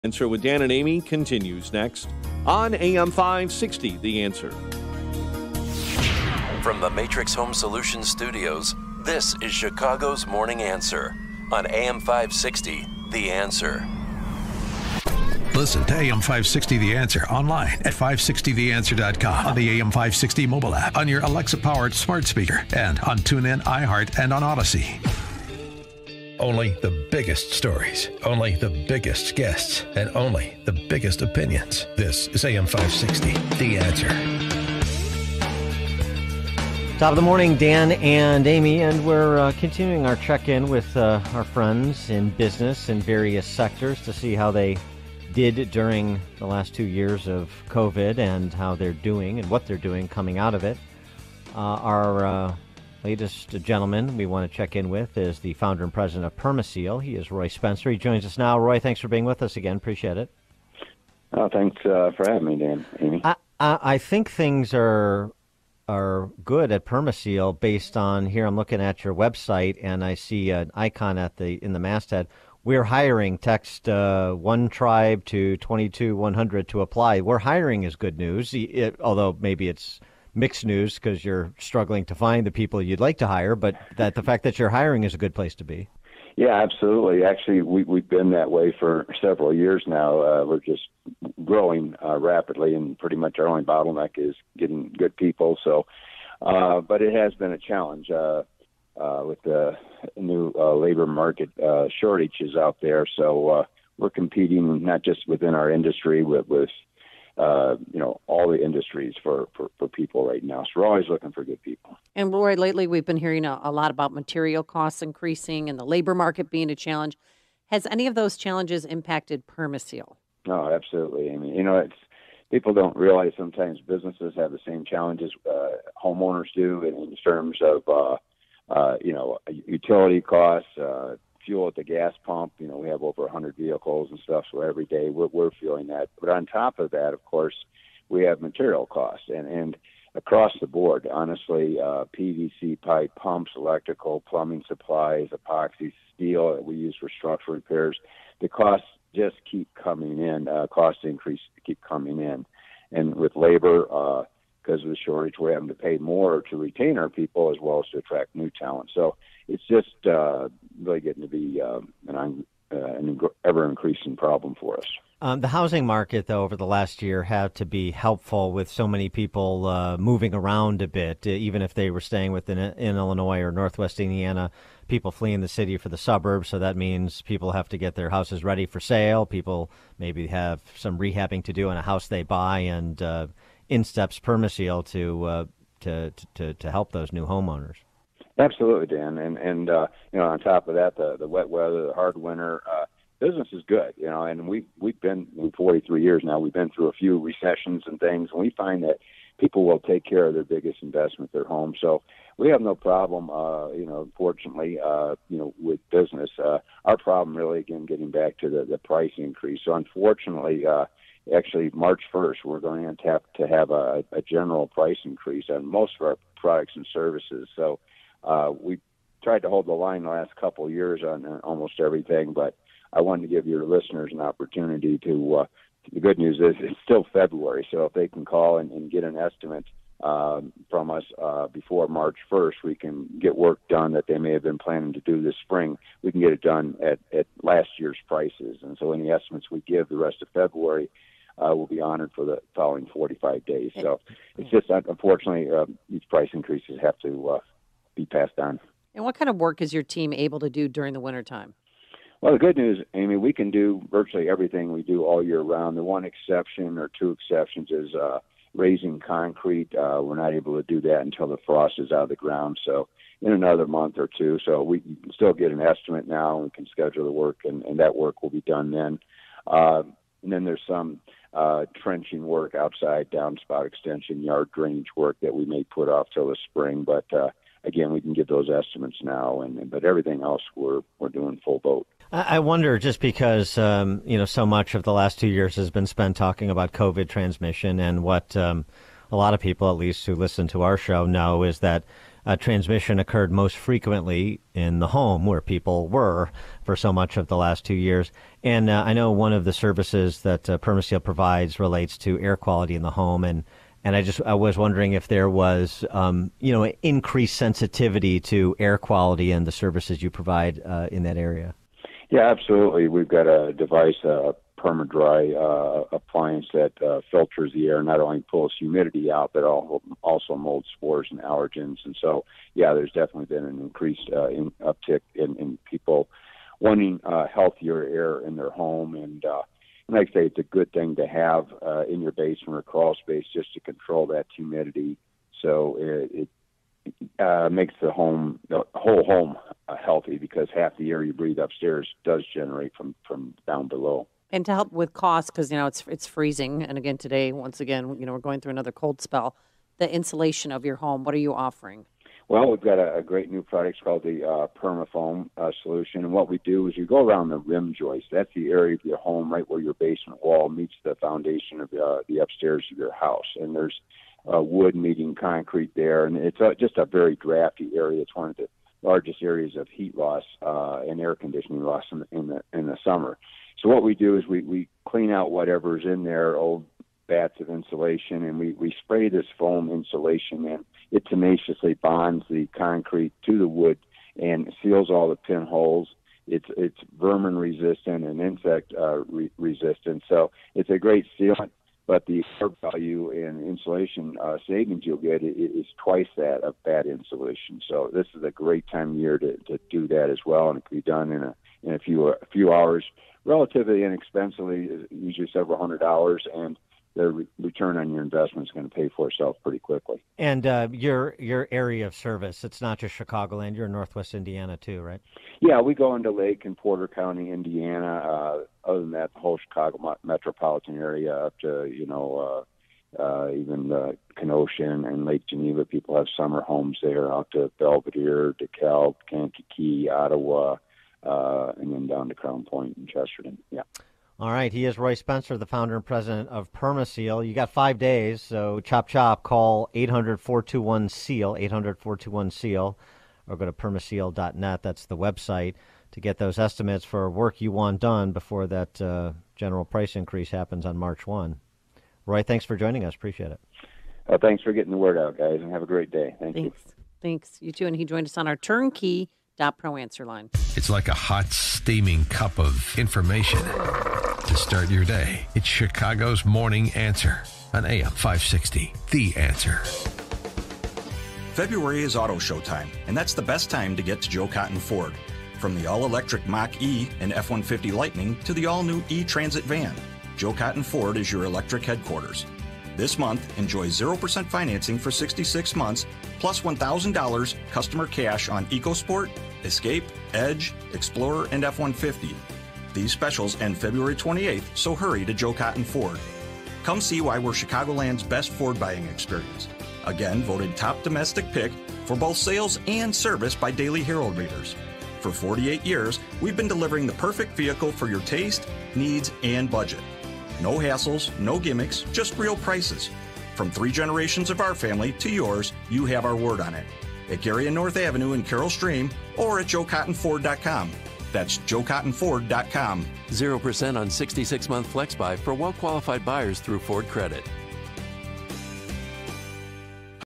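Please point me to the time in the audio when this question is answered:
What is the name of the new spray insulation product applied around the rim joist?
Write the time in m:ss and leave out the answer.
5:54.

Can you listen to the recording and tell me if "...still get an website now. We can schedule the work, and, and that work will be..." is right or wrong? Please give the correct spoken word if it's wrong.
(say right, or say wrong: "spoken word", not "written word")
wrong: "estimate", not "website".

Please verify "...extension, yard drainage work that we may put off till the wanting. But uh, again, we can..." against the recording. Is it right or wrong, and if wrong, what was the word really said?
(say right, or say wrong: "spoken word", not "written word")
wrong: "spring", not "wanting".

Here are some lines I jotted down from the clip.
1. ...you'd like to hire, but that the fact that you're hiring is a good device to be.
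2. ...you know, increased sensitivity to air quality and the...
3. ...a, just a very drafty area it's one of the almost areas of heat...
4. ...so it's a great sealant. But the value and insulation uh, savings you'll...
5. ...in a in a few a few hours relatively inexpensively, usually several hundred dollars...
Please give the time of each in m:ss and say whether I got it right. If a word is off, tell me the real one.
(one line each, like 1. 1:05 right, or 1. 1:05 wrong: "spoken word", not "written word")
1. 1:22 wrong: "place", not "device"
2. 5:06 right
3. 6:06 wrong: "largest", not "almost"
4. 6:30 right
5. 6:41 right.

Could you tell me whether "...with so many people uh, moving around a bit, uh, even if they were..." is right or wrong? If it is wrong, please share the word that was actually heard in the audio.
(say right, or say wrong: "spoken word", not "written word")
right.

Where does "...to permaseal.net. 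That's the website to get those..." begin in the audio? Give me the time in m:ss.
7:23.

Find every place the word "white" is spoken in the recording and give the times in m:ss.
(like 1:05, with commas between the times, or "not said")
not said.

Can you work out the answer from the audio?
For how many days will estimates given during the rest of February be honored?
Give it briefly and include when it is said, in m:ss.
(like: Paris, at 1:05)
45, at 4:02.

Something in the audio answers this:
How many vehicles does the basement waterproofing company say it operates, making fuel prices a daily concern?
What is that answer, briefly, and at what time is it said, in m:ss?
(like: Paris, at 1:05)
over 100, at 2:13.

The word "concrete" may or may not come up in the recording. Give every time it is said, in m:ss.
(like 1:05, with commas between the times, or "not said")
4:18, 6:05, 6:22.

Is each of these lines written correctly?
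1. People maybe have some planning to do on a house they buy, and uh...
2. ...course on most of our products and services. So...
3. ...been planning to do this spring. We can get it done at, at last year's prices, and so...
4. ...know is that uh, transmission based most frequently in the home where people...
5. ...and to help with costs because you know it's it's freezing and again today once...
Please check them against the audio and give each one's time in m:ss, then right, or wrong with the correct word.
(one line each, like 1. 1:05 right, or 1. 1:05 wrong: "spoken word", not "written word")
1. 2:59 wrong: "rehabbing", not "planning"
2. 3:35 wrong: "increase", not "course"
3. 3:54 right
4. 4:51 wrong: "occurred", not "based"
5. 5:44 right.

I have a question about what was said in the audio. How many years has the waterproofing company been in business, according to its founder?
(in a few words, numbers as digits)
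43.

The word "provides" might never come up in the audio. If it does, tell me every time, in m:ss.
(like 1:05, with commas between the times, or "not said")
5:01, 5:10.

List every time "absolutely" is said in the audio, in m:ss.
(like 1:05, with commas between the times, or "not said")
1:26, 2:00, 3:08, 5:12.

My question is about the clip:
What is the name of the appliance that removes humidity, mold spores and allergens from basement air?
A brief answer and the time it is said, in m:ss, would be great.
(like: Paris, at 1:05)
PermaDry, at 5:14.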